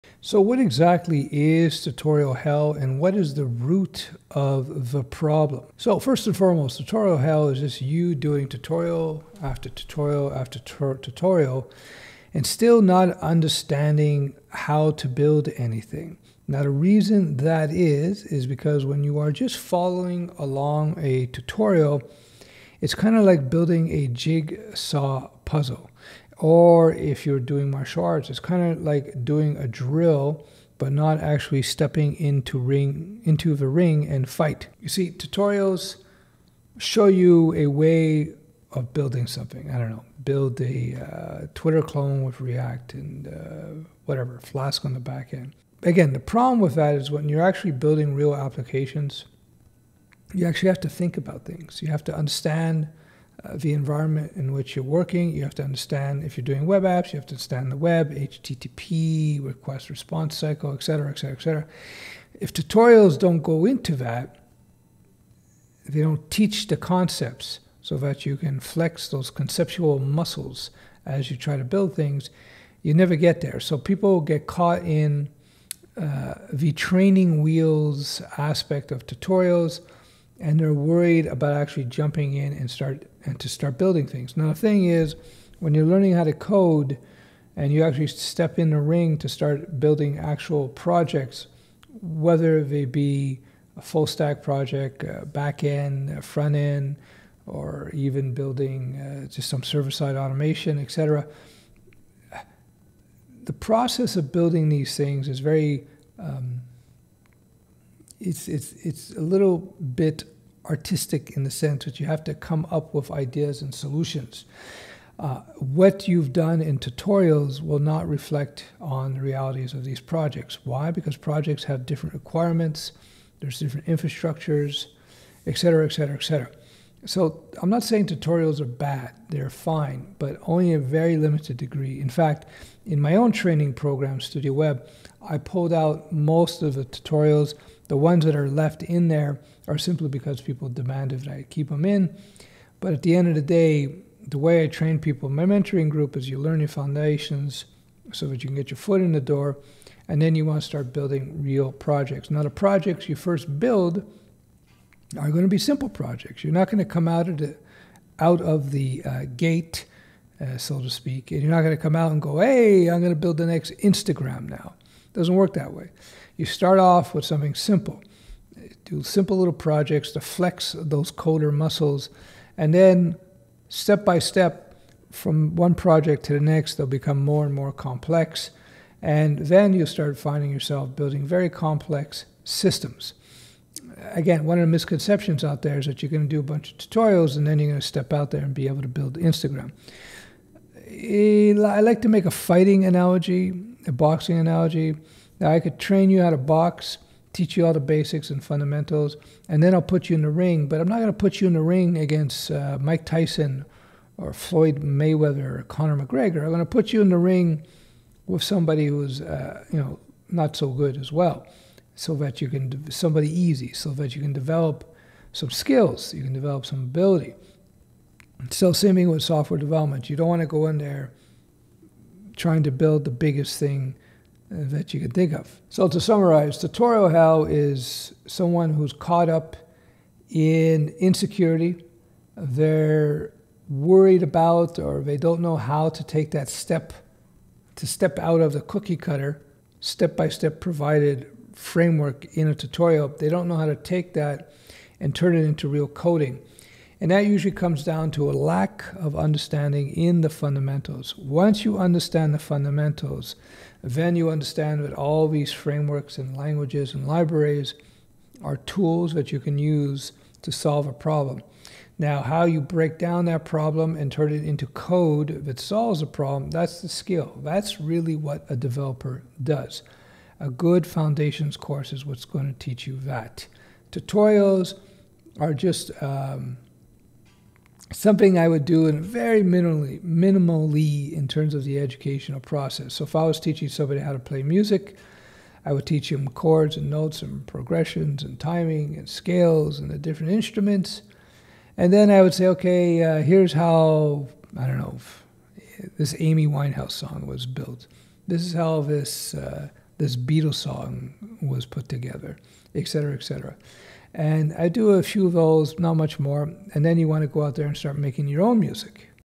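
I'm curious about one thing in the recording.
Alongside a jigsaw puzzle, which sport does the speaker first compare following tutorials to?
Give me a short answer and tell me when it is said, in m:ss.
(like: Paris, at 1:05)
martial arts, at 0:27.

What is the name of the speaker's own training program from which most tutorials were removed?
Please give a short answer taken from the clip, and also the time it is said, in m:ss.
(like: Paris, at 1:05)
Studio Web, at 2:14.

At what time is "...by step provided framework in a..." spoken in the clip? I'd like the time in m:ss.
4:00.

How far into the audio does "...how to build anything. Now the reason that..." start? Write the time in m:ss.
0:14.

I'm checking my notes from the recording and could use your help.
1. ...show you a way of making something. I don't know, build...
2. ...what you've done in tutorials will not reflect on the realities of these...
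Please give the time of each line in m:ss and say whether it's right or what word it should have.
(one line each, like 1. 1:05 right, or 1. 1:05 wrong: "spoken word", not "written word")
1. 0:36 wrong: "building", not "making"
2. 1:55 right.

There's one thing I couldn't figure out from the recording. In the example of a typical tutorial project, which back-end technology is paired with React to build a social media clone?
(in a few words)
Flask.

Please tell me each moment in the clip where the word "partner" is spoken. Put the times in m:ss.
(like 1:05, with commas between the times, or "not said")
not said.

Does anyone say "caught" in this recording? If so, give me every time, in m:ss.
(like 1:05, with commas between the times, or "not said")
1:14, 3:48.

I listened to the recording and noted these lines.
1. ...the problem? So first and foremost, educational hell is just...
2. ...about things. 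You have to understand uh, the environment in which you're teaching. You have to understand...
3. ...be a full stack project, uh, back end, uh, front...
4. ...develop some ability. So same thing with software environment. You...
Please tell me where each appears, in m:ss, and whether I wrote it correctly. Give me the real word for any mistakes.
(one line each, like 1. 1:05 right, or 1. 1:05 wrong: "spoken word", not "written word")
1. 0:04 wrong: "tutorial", not "educational"
2. 0:51 wrong: "working", not "teaching"
3. 1:32 right
4. 3:36 wrong: "development", not "environment".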